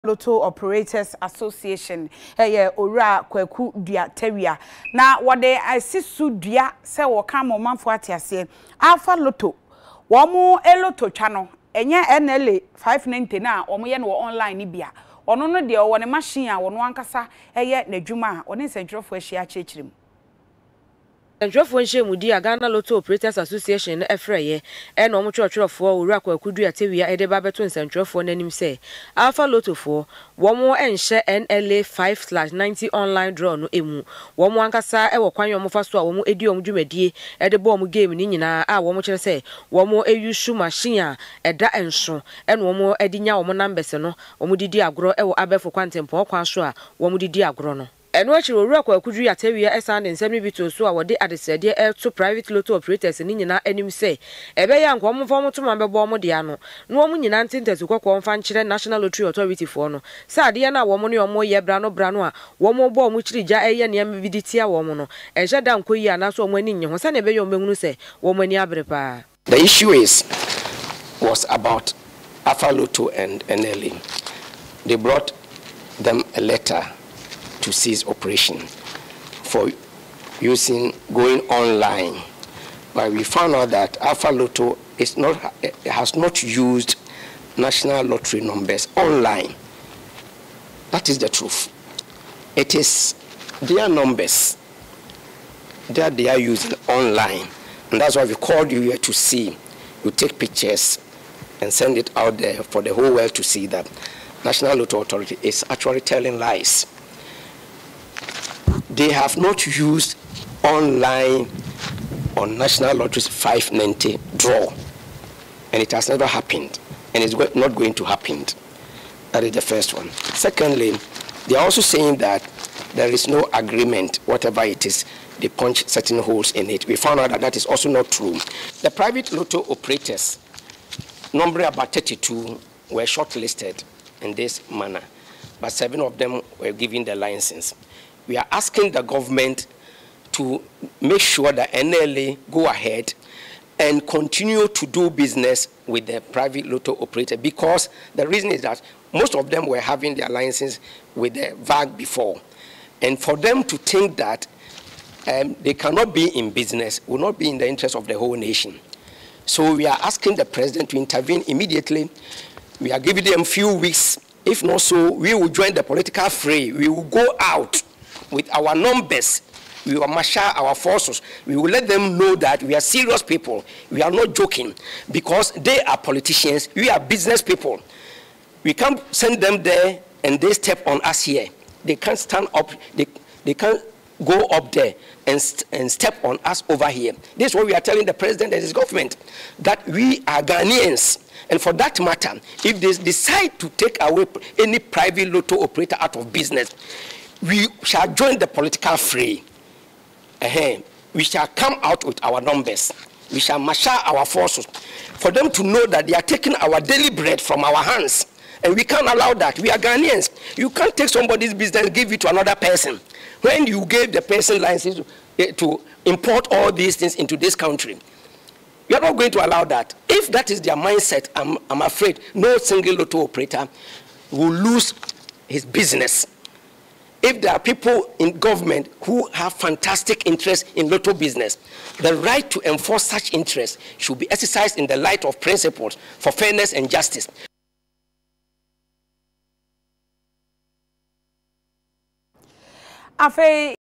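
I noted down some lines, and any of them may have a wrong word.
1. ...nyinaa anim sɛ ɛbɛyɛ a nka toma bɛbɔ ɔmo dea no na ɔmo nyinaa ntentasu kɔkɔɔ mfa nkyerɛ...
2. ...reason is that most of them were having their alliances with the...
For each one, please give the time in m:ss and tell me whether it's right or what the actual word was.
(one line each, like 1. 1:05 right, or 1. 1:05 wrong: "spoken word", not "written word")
1. 0:53 right
2. 2:28 right.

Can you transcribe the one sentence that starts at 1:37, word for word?
And that's why we called you here to see.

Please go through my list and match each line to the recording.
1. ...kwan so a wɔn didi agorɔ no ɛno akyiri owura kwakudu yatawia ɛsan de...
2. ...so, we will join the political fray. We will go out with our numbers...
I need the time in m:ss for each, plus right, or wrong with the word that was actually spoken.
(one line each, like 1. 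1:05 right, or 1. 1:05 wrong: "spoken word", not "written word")
1. 0:46 right
2. 2:44 right.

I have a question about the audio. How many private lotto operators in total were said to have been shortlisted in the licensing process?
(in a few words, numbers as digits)
32.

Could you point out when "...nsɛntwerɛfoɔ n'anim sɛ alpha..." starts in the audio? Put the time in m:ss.
0:27.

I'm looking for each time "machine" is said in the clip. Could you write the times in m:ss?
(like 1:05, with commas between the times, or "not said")
0:16, 0:40.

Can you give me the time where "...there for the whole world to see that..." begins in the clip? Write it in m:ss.
1:42.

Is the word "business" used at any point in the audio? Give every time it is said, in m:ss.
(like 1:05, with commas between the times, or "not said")
2:25, 2:36, 2:56, 3:16, 3:31, 3:45, 3:51.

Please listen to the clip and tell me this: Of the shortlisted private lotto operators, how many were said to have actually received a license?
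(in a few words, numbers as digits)
7.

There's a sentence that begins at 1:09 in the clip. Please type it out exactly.
the issue is was about afa and nla they brought them a letter to cease operation for using going online.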